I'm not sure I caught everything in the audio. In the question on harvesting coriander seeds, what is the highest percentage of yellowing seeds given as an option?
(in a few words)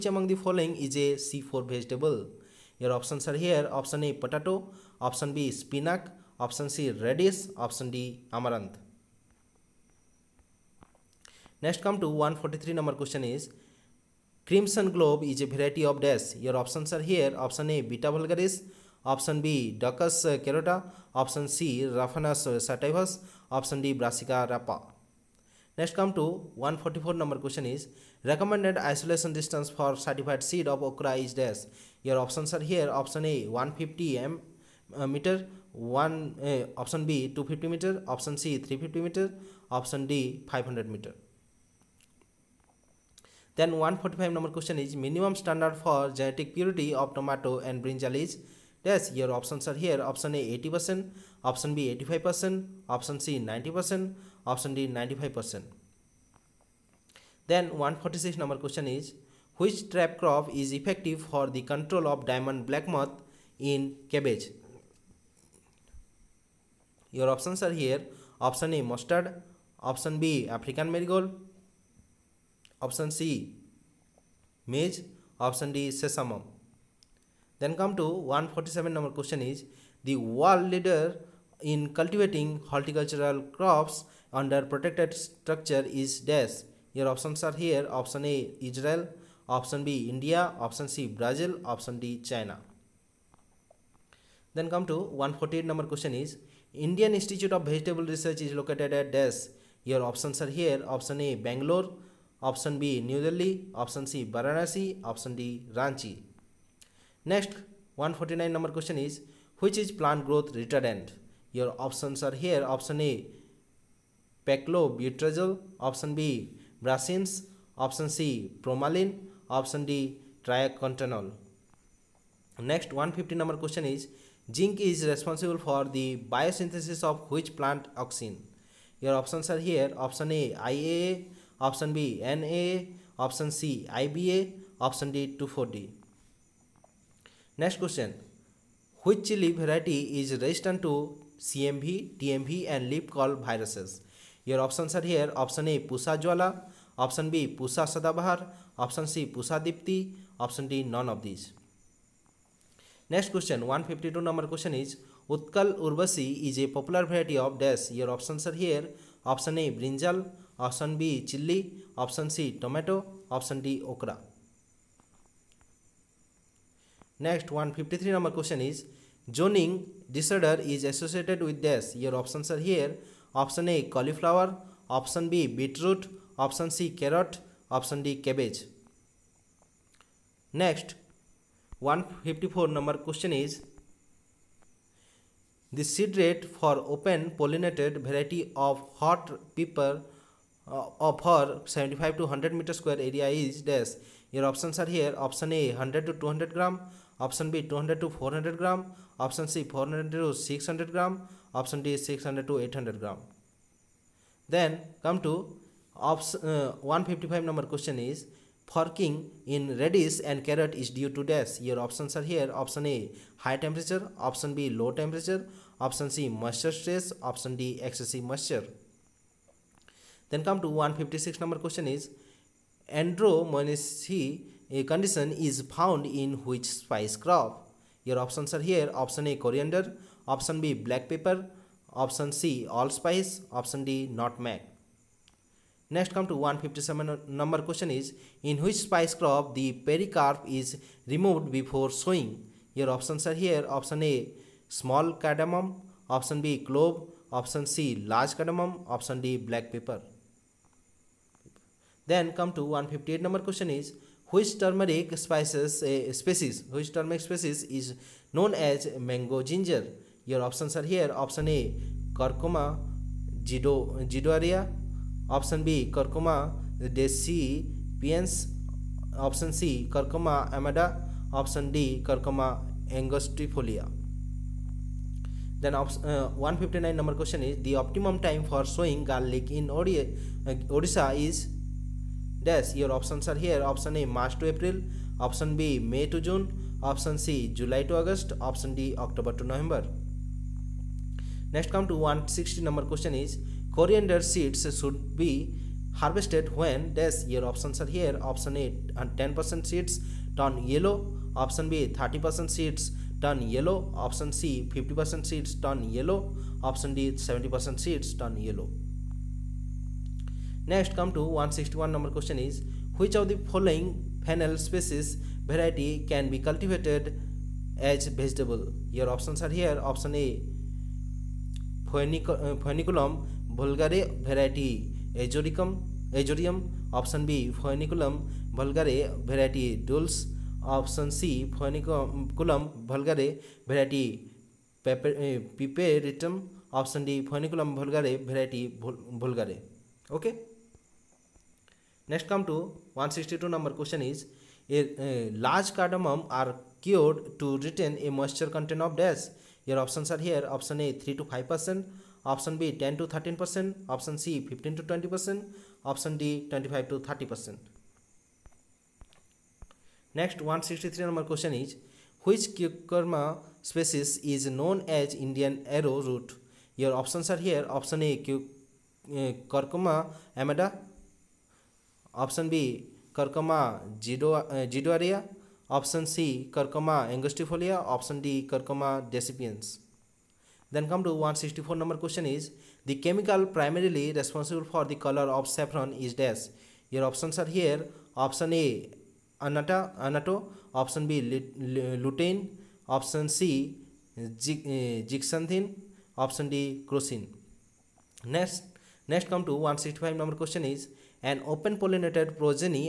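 70%.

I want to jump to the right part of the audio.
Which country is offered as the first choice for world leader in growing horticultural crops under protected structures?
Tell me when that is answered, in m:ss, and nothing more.
1:28.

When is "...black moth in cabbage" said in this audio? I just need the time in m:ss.
1:02.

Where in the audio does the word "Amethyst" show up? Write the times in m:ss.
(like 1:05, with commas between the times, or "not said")
not said.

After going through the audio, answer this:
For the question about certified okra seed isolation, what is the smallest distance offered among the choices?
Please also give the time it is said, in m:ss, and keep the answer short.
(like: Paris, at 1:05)
150 m, at 0:33.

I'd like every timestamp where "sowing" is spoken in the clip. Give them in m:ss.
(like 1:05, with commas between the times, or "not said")
4:01, 4:38.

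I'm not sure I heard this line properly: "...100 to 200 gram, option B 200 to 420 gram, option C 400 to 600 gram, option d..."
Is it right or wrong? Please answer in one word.
wrong.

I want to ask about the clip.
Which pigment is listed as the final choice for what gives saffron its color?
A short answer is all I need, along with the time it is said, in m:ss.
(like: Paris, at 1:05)
crocin, at 6:36.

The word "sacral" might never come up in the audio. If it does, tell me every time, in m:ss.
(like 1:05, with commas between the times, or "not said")
not said.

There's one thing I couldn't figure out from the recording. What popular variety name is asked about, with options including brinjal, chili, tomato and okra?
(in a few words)
Utkal Urbasi.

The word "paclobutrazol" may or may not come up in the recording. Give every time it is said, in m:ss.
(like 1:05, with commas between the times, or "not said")
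1:54.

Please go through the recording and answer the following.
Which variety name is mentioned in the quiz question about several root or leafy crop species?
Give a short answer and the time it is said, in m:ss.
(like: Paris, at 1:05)
Crimson globe, at 0:14.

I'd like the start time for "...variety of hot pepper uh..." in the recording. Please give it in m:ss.
3:08.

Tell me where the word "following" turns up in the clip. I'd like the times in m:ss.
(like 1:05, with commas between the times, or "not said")
0:00, 5:13.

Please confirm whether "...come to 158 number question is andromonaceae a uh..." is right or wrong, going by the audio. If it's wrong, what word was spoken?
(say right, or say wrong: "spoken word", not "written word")
wrong: "156", not "158".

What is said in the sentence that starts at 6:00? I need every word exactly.
Next 163 number question is which cucurma species is known as Indian arrow root?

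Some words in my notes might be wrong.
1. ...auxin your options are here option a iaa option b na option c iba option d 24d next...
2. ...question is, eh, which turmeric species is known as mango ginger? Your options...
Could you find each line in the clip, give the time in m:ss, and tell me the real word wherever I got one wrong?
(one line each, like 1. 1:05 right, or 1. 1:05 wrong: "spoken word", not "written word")
1. 2:08 right
2. 4:13 right.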